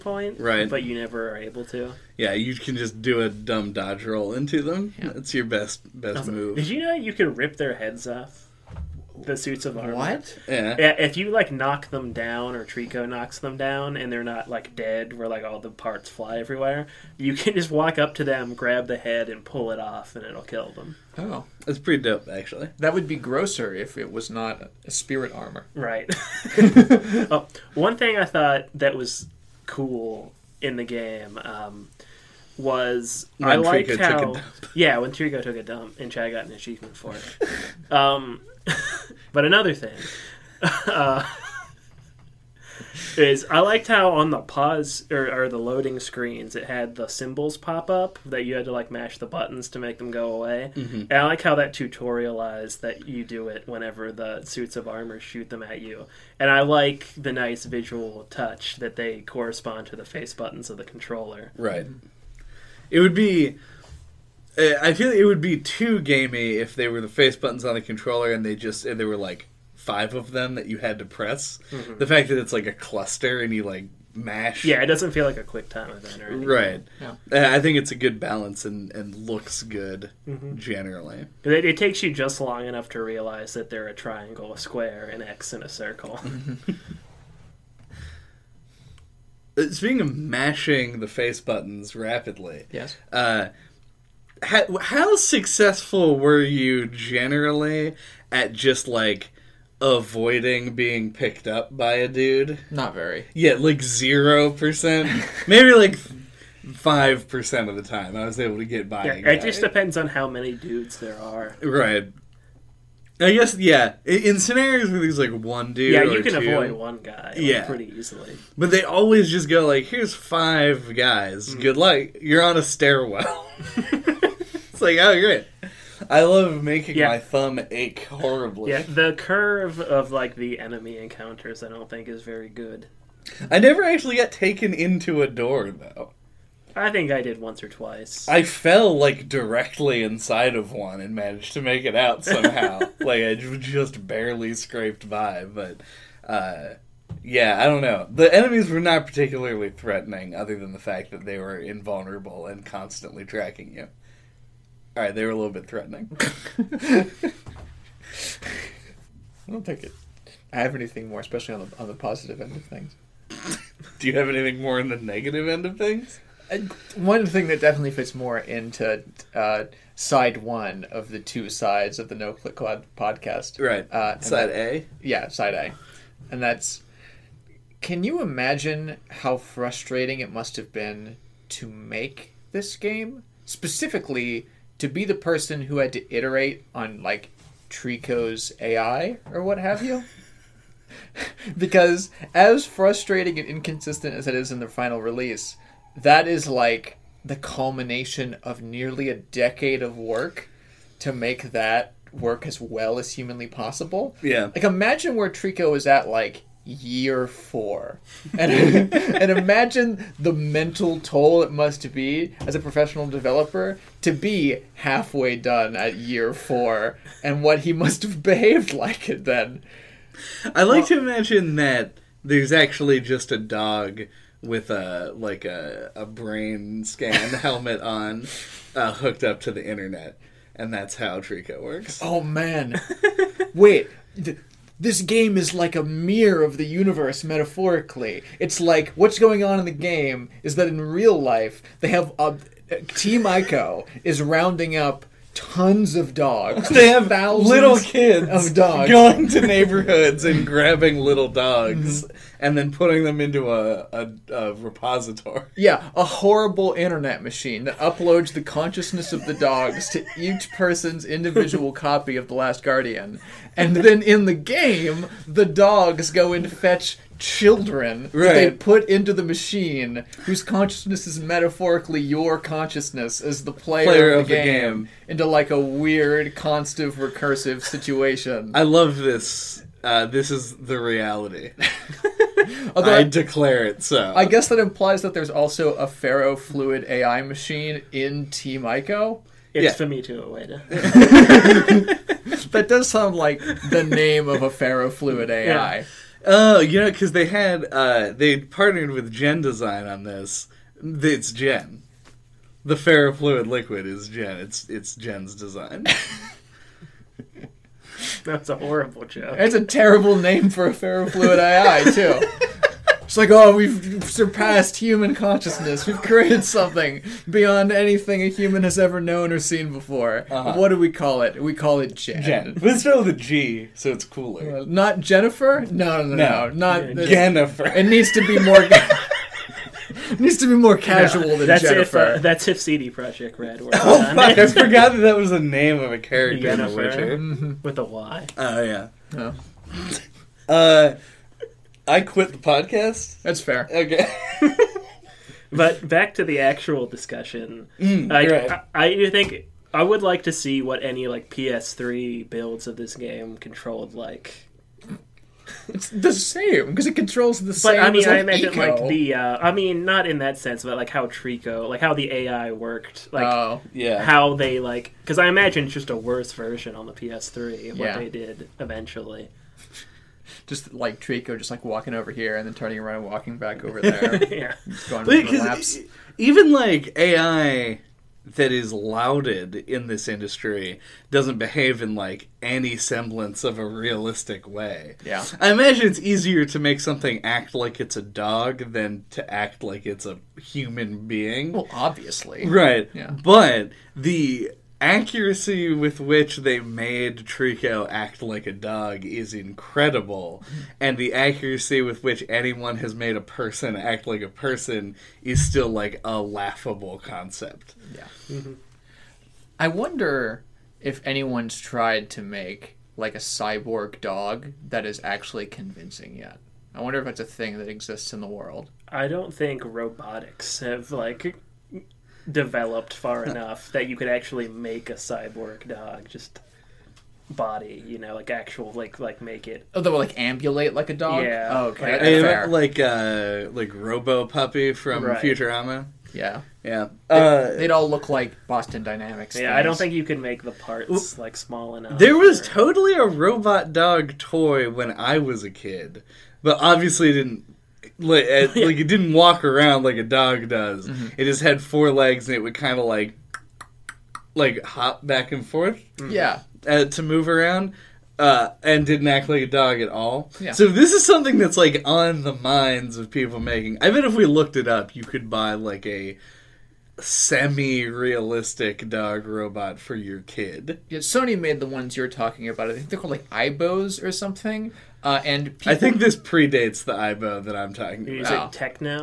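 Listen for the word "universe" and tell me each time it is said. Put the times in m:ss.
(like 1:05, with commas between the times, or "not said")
3:56.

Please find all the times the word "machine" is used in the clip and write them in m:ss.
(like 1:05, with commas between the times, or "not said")
4:17, 4:29, 4:47.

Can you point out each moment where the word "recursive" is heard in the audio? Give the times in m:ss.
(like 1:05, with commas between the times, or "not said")
4:36.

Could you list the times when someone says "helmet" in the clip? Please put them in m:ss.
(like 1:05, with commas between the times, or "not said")
3:47.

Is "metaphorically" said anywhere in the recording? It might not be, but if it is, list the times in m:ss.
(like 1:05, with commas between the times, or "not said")
3:57, 4:31.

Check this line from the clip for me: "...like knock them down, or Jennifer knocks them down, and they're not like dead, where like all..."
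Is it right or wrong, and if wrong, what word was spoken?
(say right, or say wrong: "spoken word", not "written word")
wrong: "Trico", not "Jennifer".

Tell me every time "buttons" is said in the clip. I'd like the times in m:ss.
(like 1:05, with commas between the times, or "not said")
0:49, 1:00, 1:07, 1:31.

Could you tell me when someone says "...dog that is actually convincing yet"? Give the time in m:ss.
6:53.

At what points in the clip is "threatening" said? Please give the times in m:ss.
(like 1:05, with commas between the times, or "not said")
2:29, 2:35.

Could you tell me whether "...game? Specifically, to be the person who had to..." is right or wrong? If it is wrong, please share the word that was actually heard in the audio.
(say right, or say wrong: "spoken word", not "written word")
right.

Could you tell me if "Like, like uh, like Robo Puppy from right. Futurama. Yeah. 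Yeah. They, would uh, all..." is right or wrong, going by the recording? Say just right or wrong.
right.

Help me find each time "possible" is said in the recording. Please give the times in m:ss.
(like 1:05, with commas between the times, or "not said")
3:23.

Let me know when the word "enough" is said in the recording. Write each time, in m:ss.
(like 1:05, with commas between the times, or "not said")
1:22, 7:03, 7:21.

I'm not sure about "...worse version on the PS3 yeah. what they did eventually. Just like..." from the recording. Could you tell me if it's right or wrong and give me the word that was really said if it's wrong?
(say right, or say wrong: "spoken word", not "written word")
right.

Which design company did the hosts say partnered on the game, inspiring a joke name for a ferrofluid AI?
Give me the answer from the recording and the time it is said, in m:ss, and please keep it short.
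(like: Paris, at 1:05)
Gen Design, at 4:59.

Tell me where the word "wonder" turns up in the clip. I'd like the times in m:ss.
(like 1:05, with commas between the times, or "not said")
6:49, 6:56.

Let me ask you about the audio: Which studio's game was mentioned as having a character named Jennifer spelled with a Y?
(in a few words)
CD Projekt Red.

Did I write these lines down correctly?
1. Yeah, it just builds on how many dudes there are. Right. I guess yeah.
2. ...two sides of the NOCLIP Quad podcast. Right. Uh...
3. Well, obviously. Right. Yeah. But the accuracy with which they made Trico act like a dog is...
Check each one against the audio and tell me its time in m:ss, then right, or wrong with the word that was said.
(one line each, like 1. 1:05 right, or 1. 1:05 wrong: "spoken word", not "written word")
1. 1:49 wrong: "depends", not "builds"
2. 2:51 right
3. 6:31 right.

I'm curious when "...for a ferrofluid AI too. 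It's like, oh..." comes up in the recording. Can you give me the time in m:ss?
5:10.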